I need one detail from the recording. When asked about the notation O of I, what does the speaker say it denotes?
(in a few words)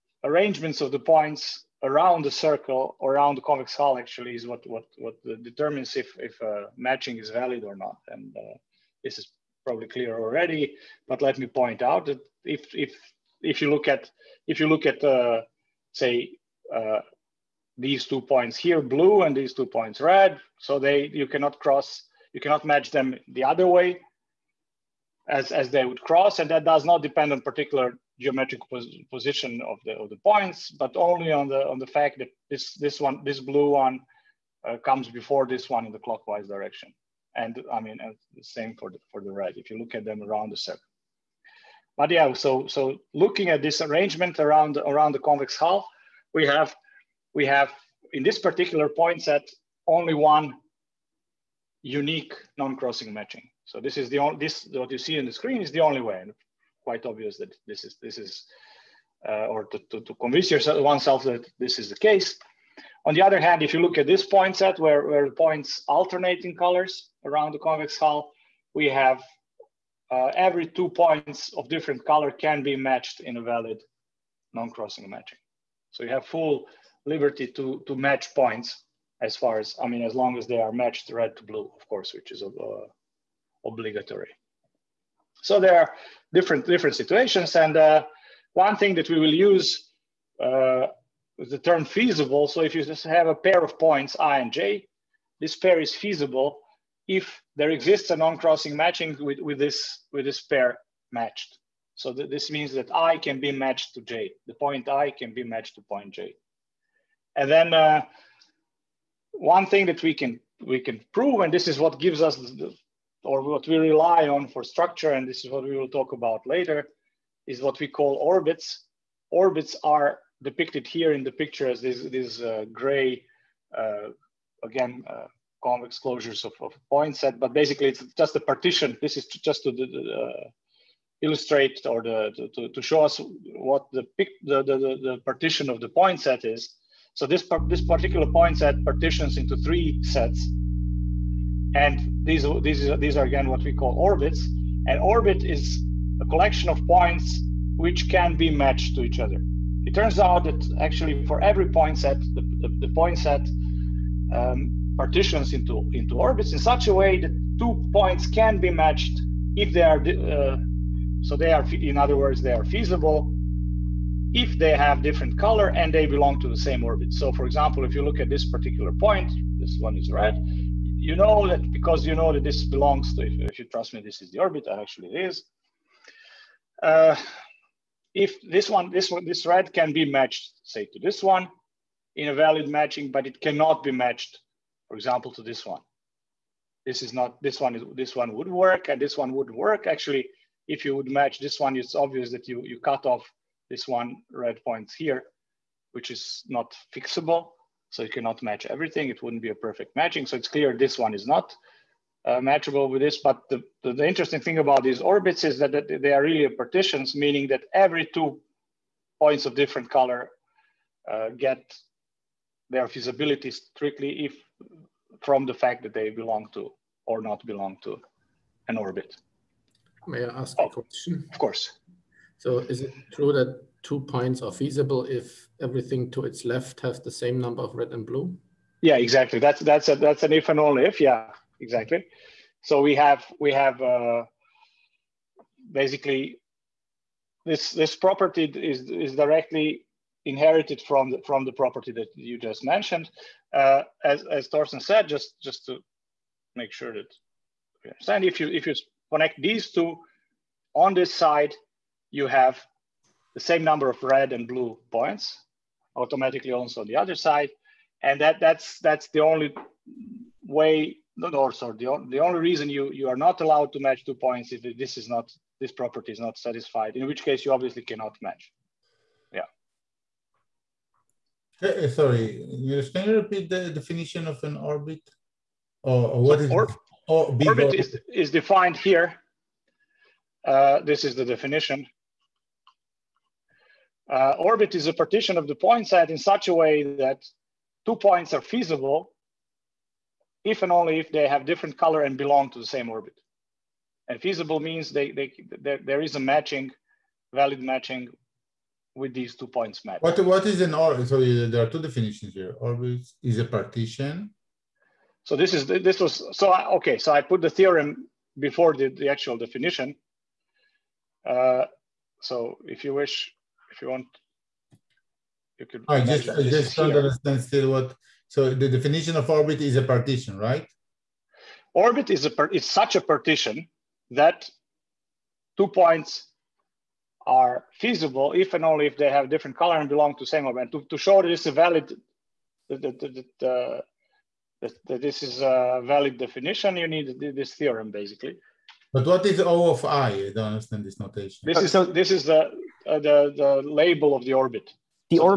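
The label of the orbit.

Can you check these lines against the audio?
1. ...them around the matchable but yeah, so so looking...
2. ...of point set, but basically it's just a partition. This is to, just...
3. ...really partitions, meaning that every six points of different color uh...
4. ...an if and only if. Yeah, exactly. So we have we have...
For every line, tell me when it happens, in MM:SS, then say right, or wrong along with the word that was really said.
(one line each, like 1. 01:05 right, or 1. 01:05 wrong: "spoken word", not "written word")
1. 00:40 wrong: "circle", not "matchable"
2. 02:06 right
3. 03:26 wrong: "two", not "six"
4. 03:50 right.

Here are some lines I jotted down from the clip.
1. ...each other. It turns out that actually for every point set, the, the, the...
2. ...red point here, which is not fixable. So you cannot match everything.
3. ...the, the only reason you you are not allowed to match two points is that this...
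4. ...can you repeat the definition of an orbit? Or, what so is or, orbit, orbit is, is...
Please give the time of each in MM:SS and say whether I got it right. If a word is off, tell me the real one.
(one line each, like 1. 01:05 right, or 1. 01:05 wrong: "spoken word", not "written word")
1. 02:29 right
2. 03:14 right
3. 04:21 right
4. 04:32 right.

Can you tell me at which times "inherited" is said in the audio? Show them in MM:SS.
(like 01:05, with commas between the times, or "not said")
04:00.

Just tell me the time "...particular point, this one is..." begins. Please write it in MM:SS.
02:48.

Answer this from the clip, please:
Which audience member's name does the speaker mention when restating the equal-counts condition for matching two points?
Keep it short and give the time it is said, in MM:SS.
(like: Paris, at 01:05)
Thorsten, at 04:04.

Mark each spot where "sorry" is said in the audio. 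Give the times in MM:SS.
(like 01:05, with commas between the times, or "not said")
04:21, 04:31.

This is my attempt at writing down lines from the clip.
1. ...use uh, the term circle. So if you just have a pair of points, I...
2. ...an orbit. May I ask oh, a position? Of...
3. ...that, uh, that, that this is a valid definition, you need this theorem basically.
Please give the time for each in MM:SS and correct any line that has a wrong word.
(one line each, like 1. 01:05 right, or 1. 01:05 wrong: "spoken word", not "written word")
1. 01:29 wrong: "feasible", not "circle"
2. 03:38 wrong: "question", not "position"
3. 05:33 right.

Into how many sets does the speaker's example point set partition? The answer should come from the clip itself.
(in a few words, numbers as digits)
3.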